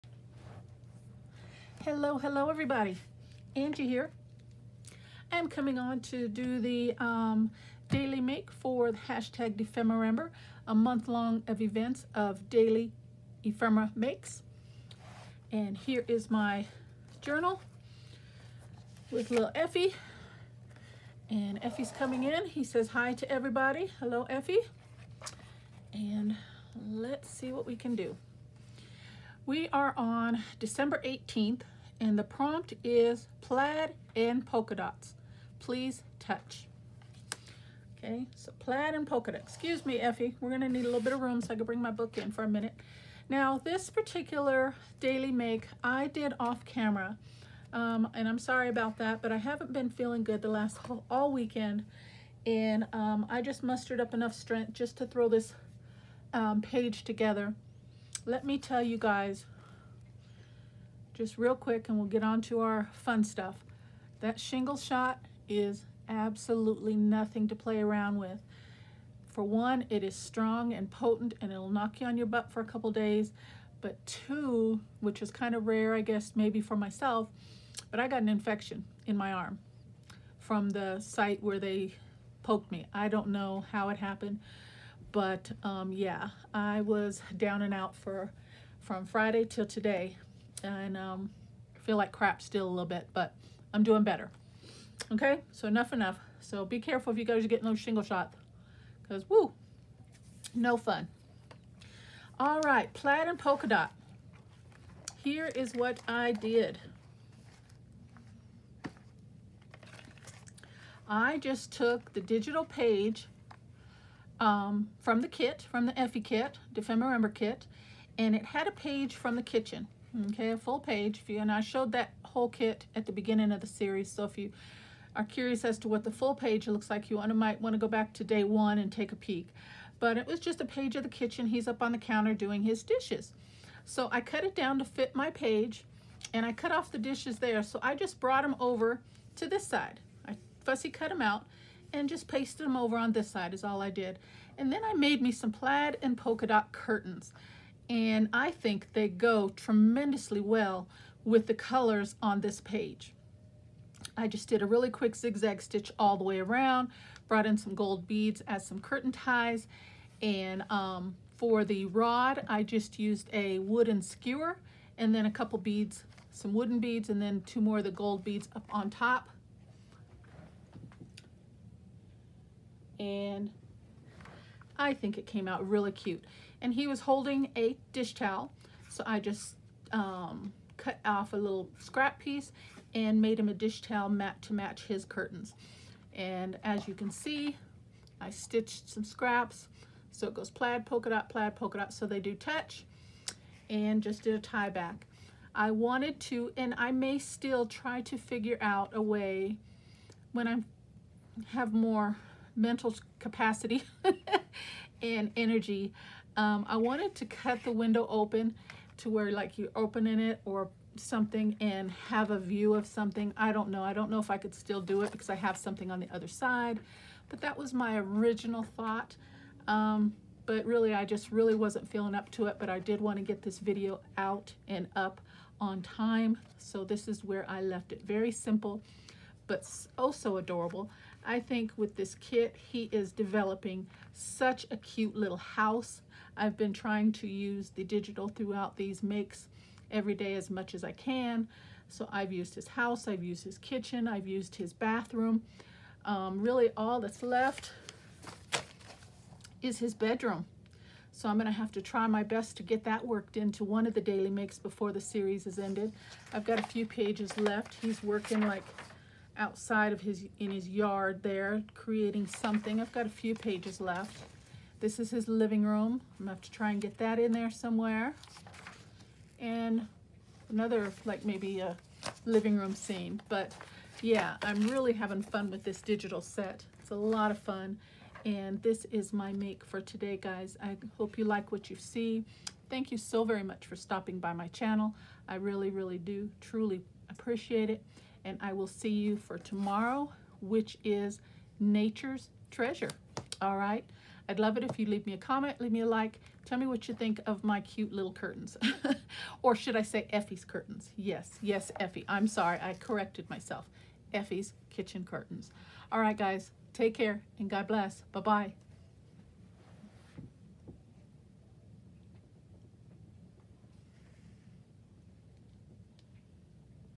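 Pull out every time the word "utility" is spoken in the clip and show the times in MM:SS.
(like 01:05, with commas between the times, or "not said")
not said.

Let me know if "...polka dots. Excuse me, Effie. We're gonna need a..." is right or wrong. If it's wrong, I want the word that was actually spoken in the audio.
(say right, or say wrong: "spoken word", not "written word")
right.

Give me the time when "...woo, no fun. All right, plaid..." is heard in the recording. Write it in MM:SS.
01:39.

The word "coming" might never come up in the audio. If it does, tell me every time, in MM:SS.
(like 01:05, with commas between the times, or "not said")
00:05, 00:21.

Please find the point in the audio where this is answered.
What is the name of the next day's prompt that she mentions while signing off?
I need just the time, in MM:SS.
04:51.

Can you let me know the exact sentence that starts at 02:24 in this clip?
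And then I made me some plaid and polka dot curtains.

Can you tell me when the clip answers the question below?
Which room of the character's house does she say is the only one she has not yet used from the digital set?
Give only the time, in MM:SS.
04:09.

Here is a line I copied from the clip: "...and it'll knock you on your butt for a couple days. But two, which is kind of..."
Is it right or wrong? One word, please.
right.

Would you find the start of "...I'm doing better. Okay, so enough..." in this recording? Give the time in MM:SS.
01:33.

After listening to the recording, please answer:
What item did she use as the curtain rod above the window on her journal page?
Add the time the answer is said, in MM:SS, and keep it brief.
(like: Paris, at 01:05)
wooden skewer, at 02:43.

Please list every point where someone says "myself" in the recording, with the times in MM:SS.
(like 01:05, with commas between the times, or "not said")
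01:16, 05:03.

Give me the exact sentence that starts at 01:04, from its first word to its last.
That shingle shot is absolutely nothing to play around with.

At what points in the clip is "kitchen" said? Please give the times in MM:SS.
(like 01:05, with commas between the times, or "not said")
01:59, 02:11, 04:03, 05:04.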